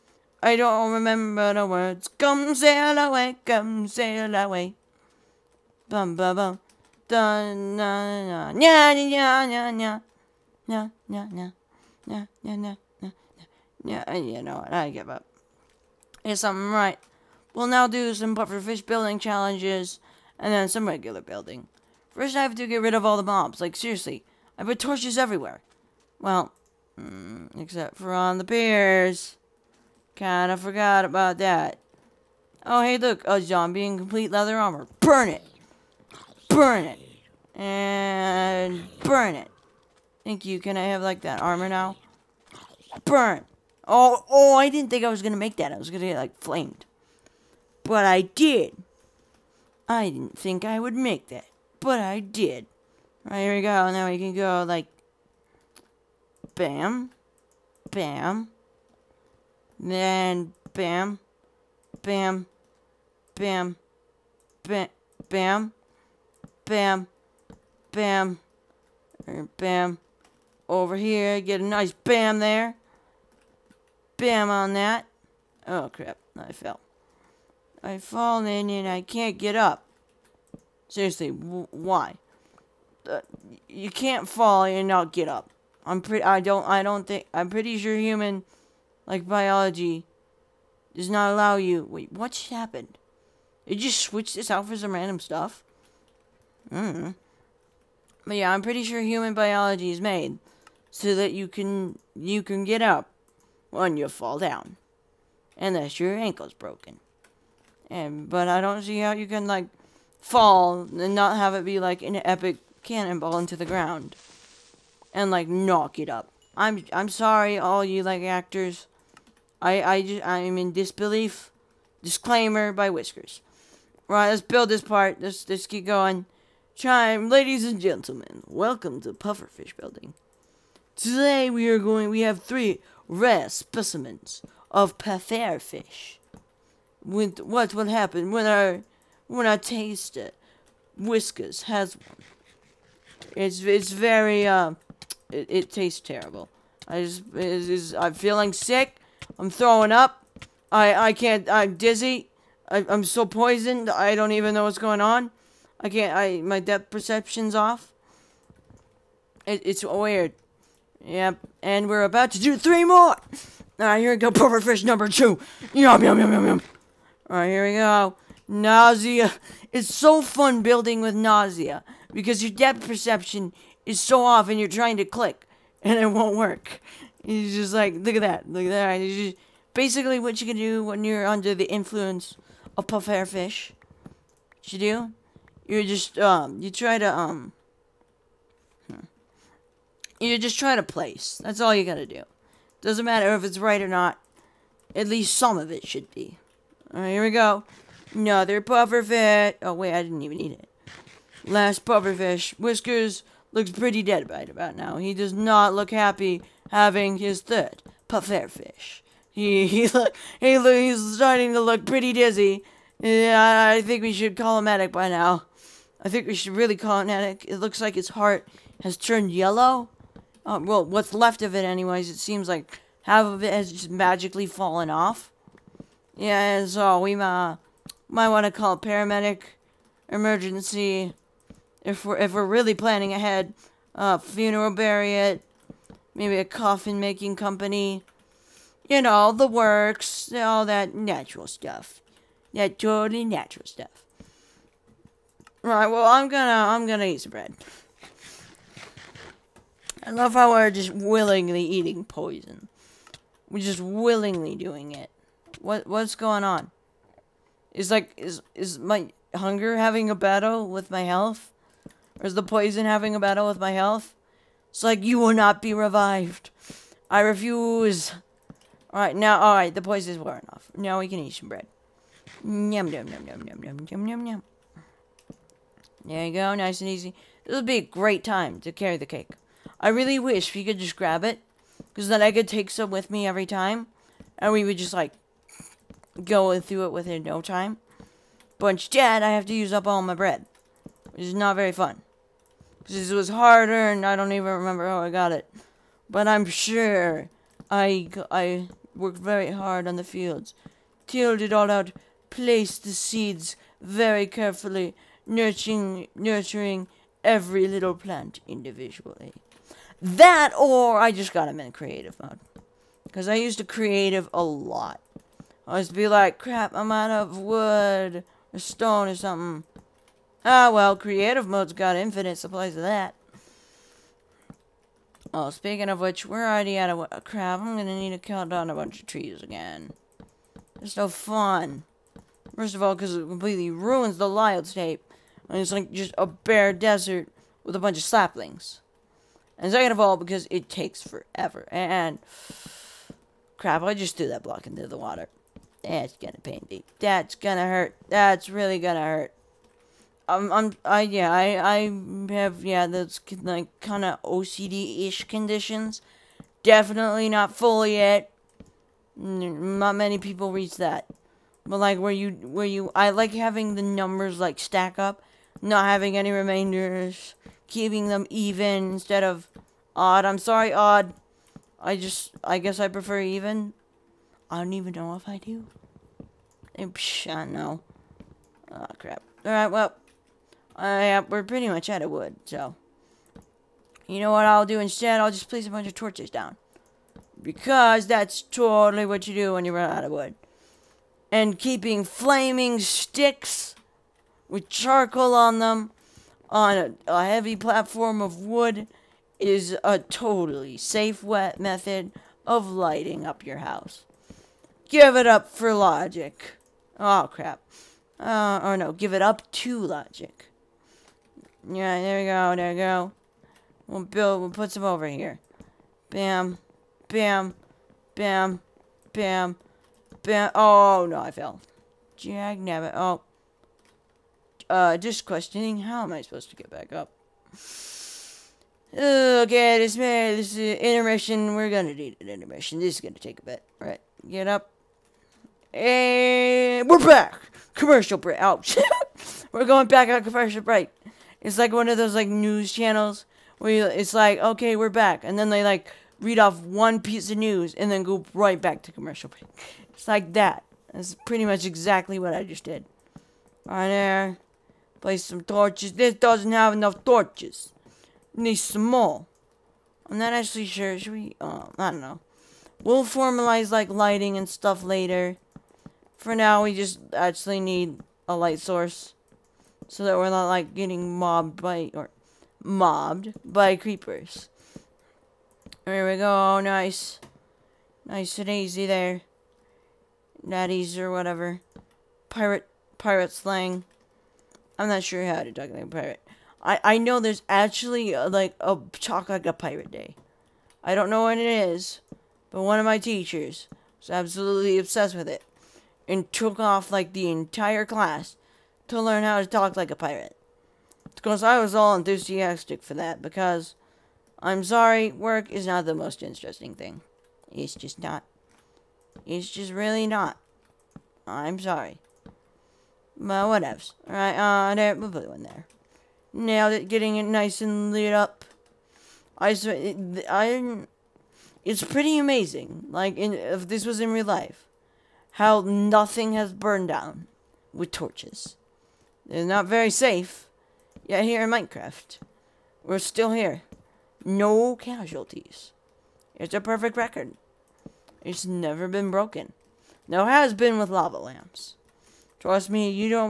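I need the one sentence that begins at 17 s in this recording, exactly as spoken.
We'll now do some pufferfish building challenges, and then some regular building.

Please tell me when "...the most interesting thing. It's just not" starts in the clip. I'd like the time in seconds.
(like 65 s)
505 s.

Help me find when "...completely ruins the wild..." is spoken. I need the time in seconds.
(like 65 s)
333 s.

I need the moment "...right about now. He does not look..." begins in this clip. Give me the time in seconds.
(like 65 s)
204 s.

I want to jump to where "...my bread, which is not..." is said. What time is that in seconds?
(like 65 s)
290 s.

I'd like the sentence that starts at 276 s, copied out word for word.
There you go, nice and easy.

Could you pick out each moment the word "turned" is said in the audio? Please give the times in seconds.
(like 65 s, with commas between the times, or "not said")
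218 s.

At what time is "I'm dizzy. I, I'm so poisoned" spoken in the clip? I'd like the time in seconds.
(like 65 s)
151 s.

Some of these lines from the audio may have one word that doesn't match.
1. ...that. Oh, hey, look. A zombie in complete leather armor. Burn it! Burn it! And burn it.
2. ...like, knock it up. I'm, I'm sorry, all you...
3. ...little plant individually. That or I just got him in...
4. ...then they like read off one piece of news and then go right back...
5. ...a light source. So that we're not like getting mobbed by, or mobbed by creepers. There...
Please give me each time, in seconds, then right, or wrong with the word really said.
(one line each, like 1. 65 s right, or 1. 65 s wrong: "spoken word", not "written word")
1. 31 s right
2. 115 s right
3. 307 s right
4. 445 s right
5. 468 s right.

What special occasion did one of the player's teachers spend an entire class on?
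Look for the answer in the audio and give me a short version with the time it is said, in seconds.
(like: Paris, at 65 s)
Talk like a pirate day, at 488 s.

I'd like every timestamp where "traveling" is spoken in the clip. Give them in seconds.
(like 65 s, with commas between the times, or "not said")
not said.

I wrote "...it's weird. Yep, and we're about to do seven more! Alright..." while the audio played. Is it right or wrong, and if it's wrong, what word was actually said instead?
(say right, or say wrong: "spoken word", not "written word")
wrong: "three", not "seven".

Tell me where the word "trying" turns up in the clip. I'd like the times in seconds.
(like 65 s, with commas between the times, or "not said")
174 s, 190 s.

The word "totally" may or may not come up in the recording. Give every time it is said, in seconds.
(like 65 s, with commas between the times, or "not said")
242 s, 388 s, 399 s.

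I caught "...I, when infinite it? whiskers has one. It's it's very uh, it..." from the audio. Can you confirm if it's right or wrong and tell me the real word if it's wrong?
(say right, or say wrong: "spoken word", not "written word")
wrong: "taste", not "infinite".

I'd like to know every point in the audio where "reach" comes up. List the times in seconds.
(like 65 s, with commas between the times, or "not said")
360 s.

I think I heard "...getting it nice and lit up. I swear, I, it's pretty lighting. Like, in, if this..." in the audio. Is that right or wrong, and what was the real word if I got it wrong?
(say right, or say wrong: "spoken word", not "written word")
wrong: "amazing", not "lighting".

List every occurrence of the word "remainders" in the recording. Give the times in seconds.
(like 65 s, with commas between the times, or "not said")
366 s.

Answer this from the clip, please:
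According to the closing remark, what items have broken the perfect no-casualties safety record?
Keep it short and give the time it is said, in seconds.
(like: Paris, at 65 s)
Lava lamps, at 540 s.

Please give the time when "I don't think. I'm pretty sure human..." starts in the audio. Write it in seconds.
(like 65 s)
86 s.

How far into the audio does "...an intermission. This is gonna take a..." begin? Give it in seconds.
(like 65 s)
432 s.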